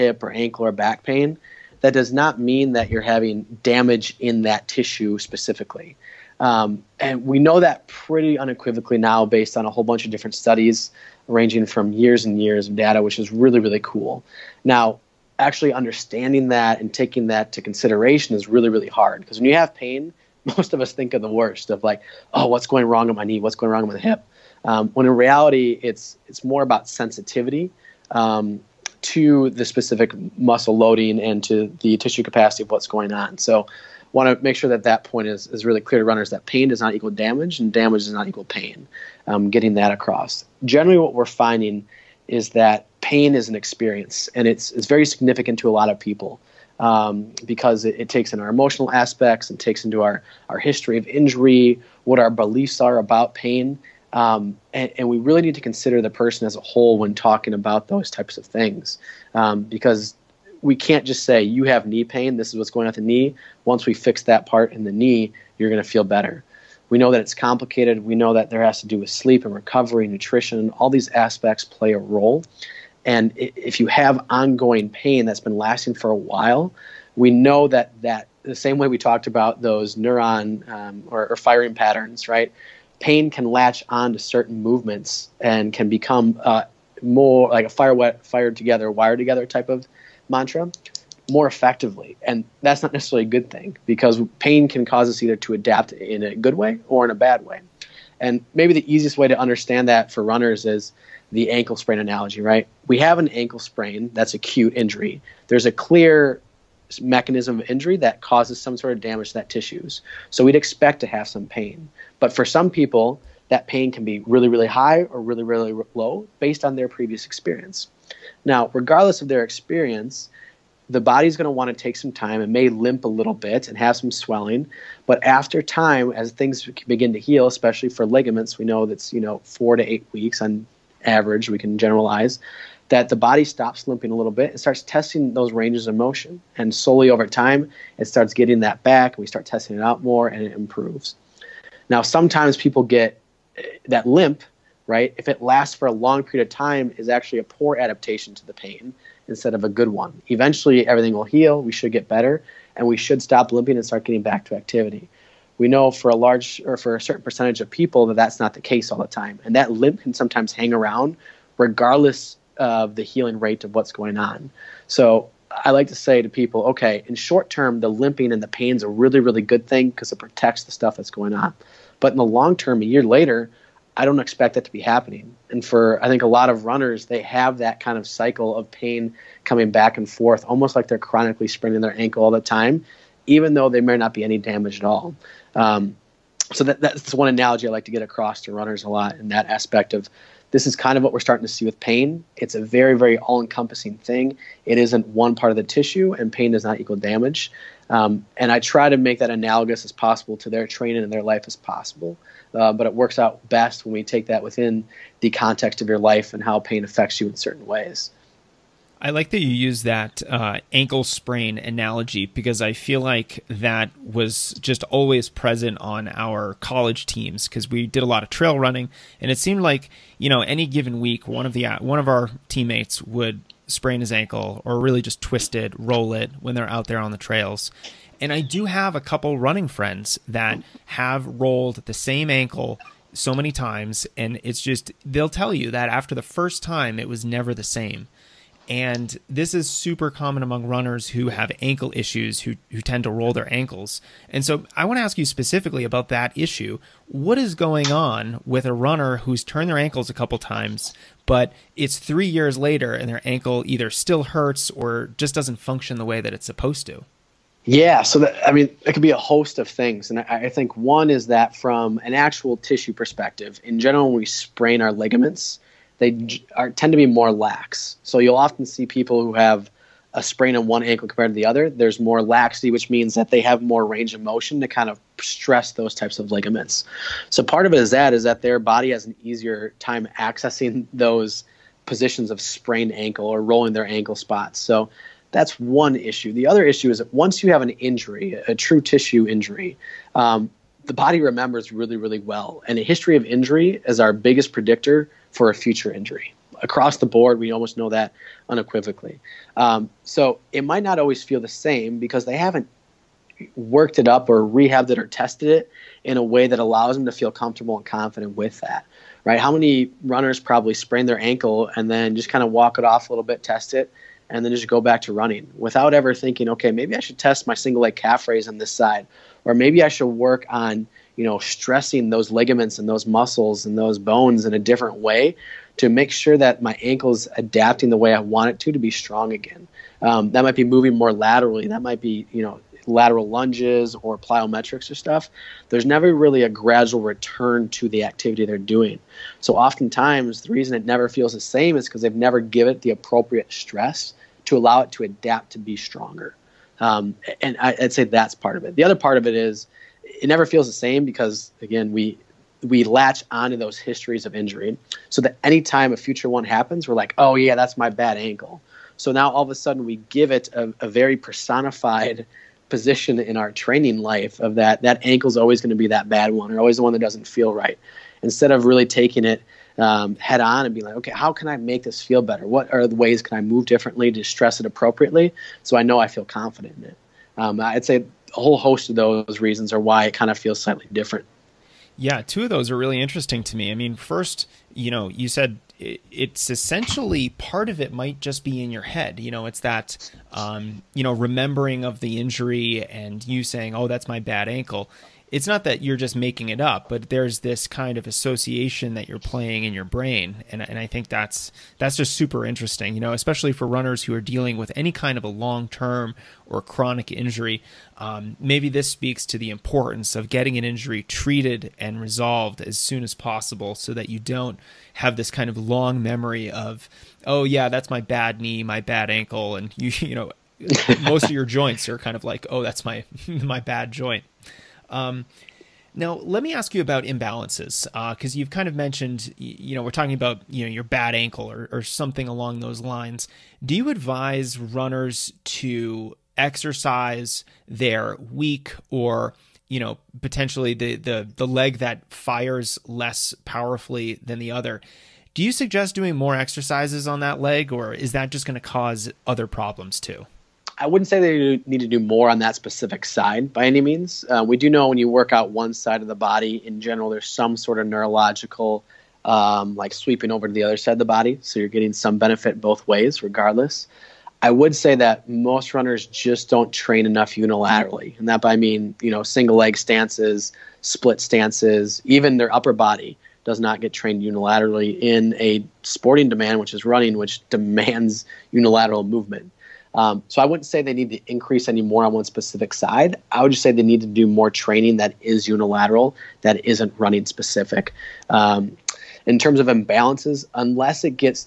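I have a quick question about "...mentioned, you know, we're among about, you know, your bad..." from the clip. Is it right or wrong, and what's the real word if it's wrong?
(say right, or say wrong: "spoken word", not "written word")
wrong: "talking", not "among".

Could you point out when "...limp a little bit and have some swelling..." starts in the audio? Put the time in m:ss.
2:02.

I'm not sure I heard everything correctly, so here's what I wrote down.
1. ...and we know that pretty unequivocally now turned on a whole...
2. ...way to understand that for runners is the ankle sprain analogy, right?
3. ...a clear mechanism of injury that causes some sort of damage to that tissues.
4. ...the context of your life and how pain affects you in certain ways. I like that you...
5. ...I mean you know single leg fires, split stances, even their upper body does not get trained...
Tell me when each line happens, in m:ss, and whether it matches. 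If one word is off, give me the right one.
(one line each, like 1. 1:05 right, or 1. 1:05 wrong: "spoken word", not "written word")
1. 0:06 wrong: "based", not "turned"
2. 1:39 right
3. 1:45 right
4. 3:25 right
5. 7:48 wrong: "stances", not "fires".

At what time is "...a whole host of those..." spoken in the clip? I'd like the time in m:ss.
6:18.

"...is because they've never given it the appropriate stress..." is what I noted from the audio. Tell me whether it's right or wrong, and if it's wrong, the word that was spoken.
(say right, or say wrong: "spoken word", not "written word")
right.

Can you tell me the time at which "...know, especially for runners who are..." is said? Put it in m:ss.
6:43.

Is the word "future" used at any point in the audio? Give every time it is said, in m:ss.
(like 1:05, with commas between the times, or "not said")
4:55, 5:55.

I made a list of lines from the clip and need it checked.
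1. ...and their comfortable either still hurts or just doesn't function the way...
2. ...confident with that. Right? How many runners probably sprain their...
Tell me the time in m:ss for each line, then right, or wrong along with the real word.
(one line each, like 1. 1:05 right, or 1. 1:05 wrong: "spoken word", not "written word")
1. 4:12 wrong: "ankle", not "comfortable"
2. 5:07 right.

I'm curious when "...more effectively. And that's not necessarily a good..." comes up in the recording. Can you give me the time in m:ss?
1:31.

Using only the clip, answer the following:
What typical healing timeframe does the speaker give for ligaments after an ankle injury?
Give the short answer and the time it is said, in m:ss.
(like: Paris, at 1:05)
4 to 8 weeks, at 2:09.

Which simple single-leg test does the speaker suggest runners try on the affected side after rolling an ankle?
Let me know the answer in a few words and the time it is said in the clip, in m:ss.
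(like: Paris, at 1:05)
Single leg calf raise, at 5:17.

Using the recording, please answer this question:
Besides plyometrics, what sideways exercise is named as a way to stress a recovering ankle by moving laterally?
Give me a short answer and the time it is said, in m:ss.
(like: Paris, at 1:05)
Lateral lunges, at 5:32.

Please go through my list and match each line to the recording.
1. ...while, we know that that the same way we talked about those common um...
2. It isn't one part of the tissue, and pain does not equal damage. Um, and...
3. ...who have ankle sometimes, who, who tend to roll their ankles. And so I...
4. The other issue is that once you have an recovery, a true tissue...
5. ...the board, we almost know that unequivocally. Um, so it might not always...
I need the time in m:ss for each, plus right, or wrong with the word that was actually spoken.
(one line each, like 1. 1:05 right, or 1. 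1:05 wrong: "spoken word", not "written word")
1. 1:16 wrong: "neuron", not "common"
2. 3:14 right
3. 4:01 wrong: "issues", not "sometimes"
4. 4:46 wrong: "injury", not "recovery"
5. 4:56 right.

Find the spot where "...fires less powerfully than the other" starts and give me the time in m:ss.
7:22.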